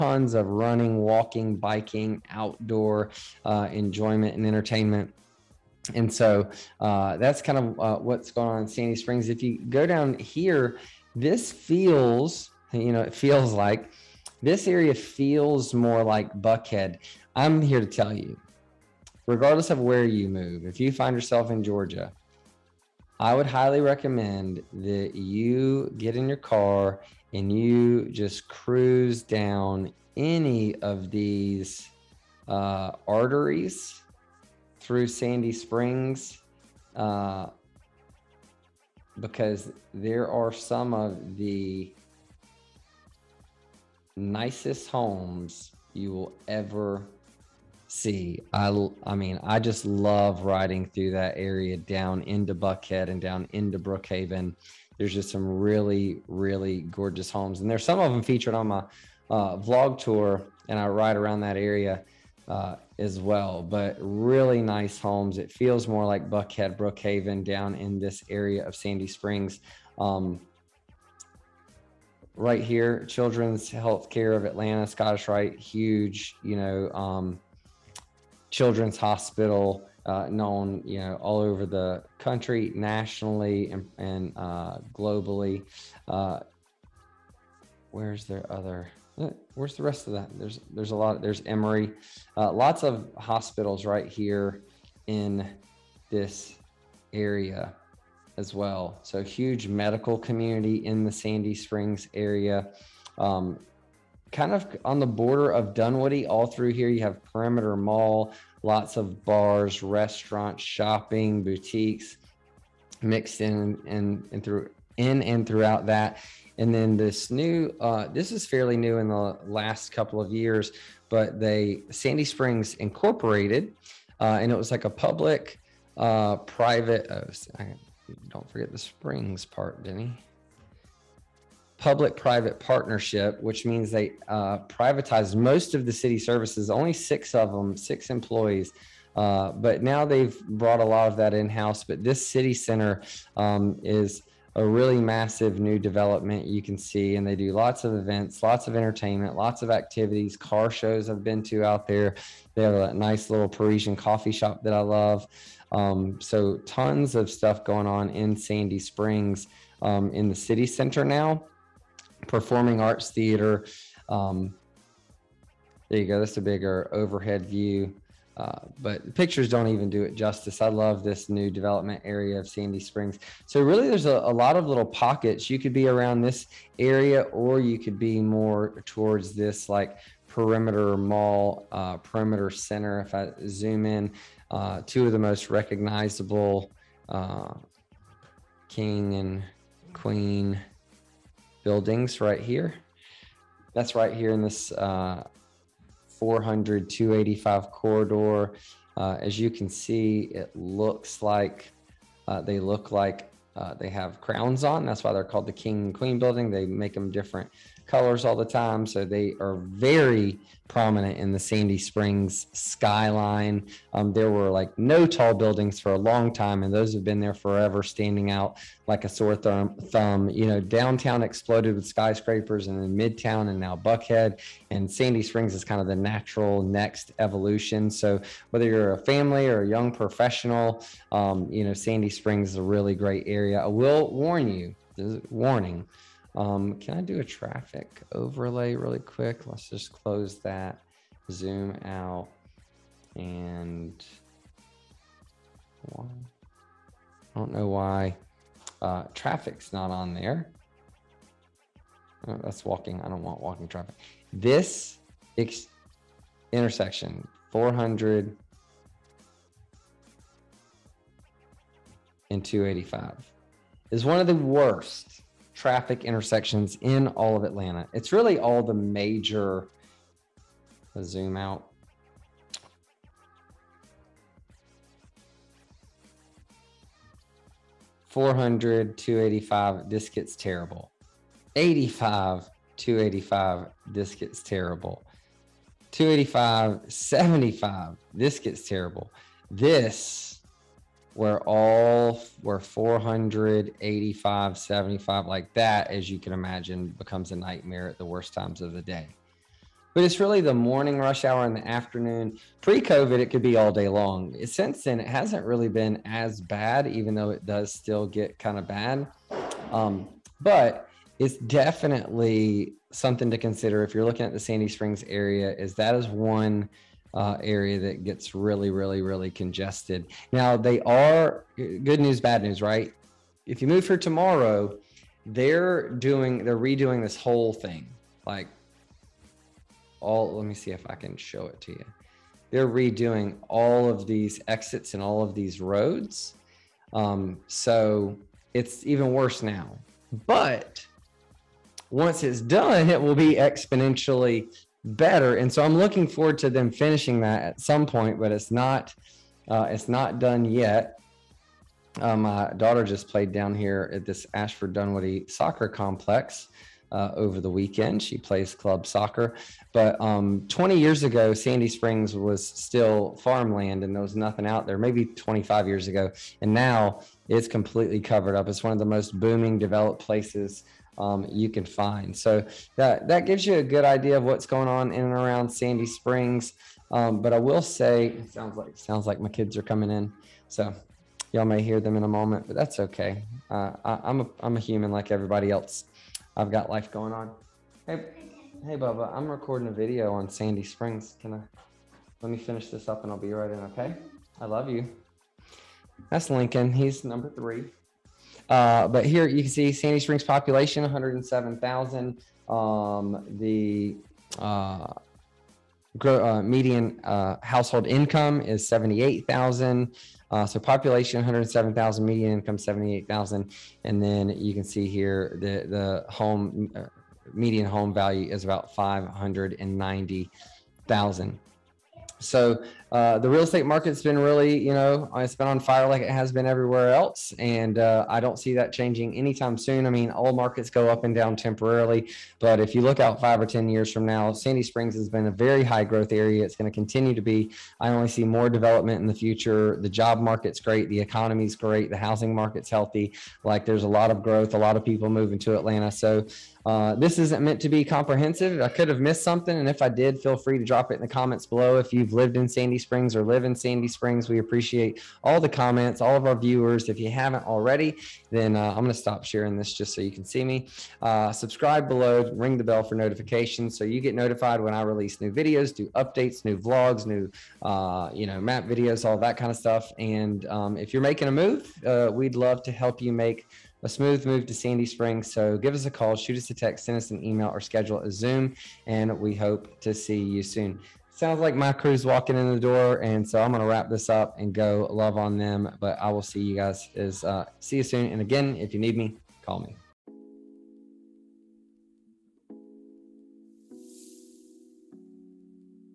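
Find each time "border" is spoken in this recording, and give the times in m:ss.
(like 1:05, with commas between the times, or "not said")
1:45.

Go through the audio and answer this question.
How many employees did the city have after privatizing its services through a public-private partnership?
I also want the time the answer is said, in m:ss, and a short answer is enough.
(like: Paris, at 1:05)
6, at 2:17.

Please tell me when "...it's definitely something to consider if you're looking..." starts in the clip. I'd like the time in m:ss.
5:11.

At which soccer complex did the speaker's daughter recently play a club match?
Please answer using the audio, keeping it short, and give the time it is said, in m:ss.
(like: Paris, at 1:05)
Ashford Dunwoody, at 5:54.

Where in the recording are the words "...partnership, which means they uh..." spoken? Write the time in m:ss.
2:12.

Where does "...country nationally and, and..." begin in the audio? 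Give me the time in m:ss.
1:22.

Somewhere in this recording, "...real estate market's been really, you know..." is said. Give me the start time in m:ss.
7:03.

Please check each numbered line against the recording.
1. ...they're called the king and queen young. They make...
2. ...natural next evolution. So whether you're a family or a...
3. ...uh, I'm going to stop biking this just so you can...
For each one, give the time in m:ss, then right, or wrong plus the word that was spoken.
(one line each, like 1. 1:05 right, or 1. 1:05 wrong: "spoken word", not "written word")
1. 3:25 wrong: "building", not "young"
2. 3:45 right
3. 7:38 wrong: "sharing", not "biking".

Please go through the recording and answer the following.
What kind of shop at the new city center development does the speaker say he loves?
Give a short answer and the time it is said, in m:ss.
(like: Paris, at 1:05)
Parisian coffee shop, at 2:33.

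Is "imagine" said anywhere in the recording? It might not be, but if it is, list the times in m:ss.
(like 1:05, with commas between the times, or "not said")
4:56.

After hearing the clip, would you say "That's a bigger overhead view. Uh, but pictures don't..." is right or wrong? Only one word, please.
right.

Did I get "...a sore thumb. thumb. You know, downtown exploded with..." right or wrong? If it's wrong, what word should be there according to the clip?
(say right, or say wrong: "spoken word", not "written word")
right.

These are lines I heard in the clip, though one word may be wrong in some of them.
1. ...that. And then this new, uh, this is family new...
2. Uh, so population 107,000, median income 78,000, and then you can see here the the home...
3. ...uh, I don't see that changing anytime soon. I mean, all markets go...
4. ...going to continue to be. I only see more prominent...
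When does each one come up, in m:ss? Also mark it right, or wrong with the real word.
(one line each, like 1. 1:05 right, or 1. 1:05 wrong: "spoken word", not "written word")
1. 1:55 wrong: "fairly", not "family"
2. 6:50 right
3. 7:07 right
4. 7:16 wrong: "development", not "prominent".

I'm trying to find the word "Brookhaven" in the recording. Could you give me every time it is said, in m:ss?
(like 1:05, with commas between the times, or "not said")
0:53, 1:06.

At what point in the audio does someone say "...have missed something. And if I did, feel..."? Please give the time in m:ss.
7:28.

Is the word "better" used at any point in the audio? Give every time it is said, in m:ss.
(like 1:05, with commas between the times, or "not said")
5:44.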